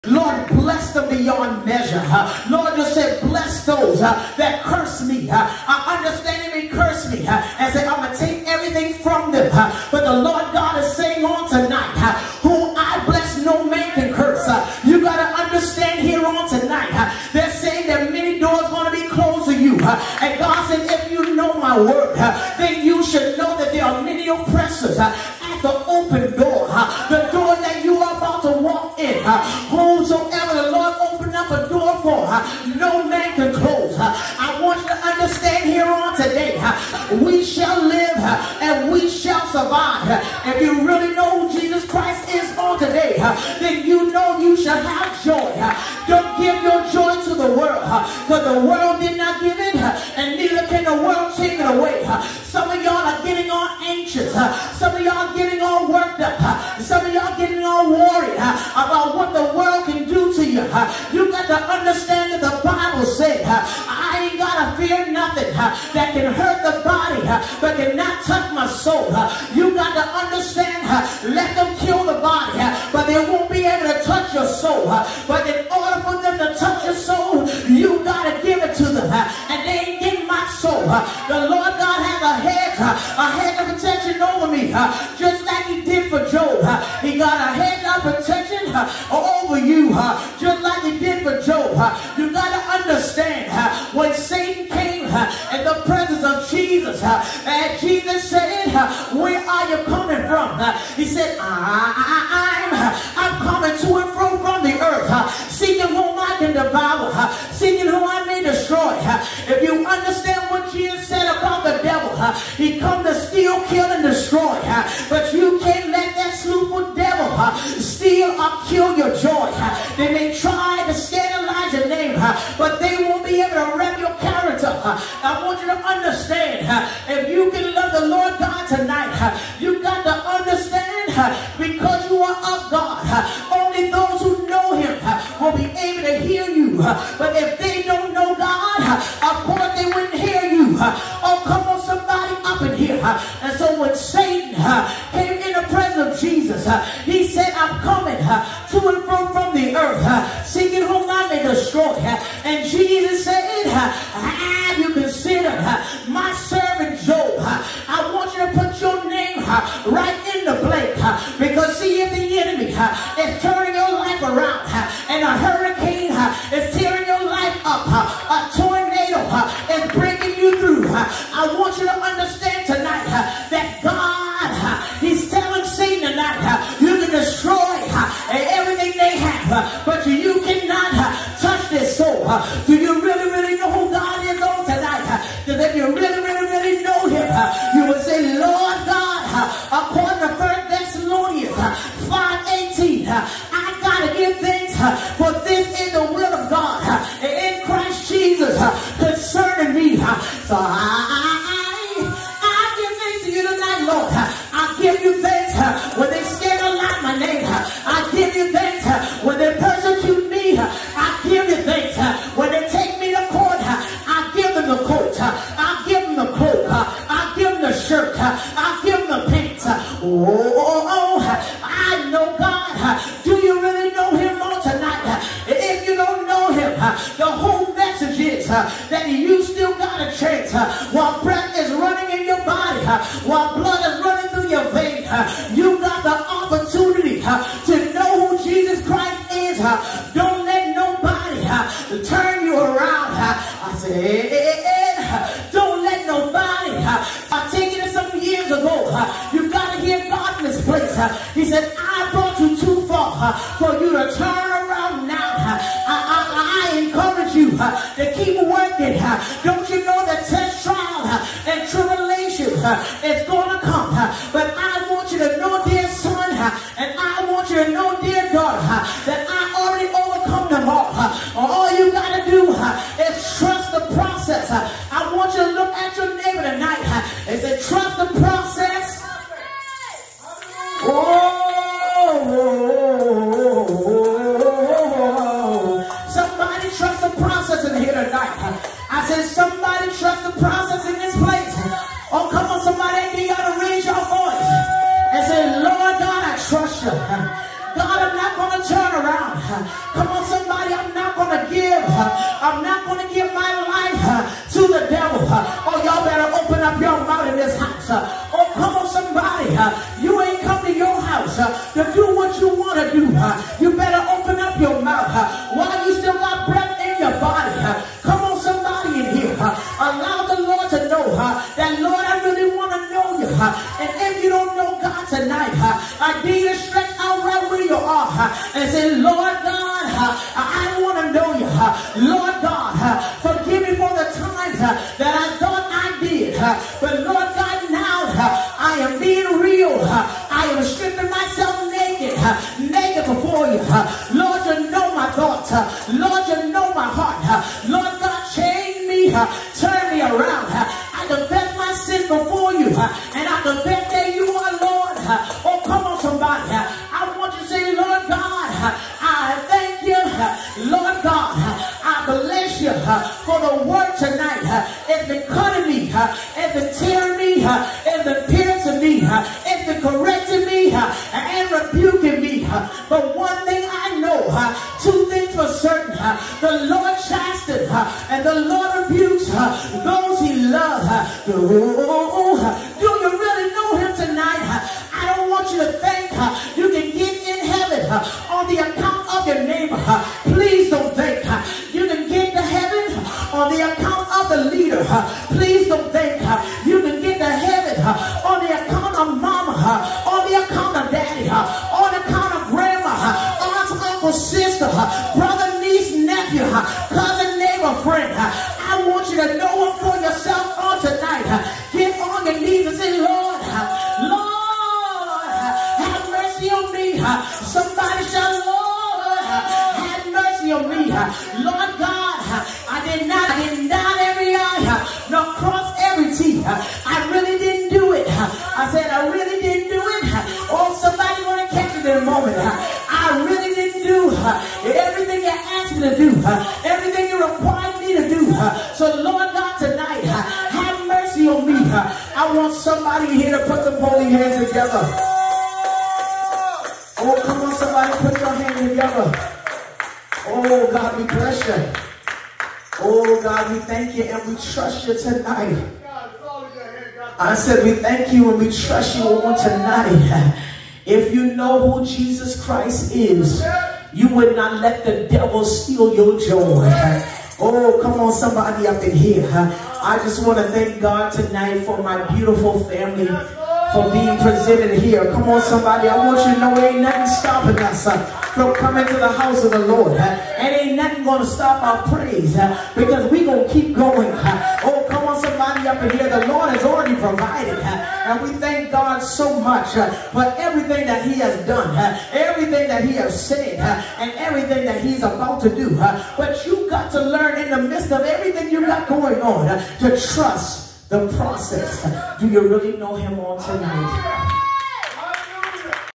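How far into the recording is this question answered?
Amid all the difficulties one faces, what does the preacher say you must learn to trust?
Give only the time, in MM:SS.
08:20.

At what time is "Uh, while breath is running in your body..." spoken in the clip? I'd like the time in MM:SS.
03:50.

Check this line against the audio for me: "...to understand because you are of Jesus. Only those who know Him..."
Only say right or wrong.
wrong.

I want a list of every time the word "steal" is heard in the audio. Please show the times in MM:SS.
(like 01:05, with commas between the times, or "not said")
01:53, 01:57, 07:45.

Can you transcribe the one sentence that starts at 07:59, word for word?
Uh, and ain't nothing going to stop our praise uh, because we going to keep going.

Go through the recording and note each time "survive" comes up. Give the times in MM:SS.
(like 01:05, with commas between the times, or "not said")
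00:39.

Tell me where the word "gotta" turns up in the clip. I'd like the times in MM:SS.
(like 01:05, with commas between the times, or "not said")
01:04, 01:18.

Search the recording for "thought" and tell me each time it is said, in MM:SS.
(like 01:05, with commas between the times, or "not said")
05:35, 05:45.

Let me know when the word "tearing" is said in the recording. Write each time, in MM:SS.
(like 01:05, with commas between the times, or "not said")
02:46, 06:06.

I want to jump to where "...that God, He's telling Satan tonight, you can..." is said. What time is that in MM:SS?
02:53.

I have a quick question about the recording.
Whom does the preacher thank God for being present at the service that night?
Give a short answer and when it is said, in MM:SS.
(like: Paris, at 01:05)
my beautiful family, at 07:51.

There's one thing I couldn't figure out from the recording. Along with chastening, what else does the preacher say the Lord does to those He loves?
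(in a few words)
rebukes.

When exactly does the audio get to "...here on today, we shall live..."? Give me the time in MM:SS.
00:35.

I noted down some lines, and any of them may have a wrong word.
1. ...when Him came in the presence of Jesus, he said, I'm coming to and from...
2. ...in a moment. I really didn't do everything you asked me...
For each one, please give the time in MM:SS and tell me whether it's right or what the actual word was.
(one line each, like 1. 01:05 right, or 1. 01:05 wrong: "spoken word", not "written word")
1. 02:23 wrong: "Satan", not "Him"
2. 07:11 right.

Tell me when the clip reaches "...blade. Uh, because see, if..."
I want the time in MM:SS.
02:40.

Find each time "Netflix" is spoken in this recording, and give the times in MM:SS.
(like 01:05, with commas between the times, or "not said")
not said.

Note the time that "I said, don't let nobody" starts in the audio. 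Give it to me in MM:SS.
04:03.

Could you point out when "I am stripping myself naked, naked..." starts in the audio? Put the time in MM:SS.
05:39.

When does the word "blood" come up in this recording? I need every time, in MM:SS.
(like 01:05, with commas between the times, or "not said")
03:53.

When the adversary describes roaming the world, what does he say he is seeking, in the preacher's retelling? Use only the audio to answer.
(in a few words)
whom I can devour.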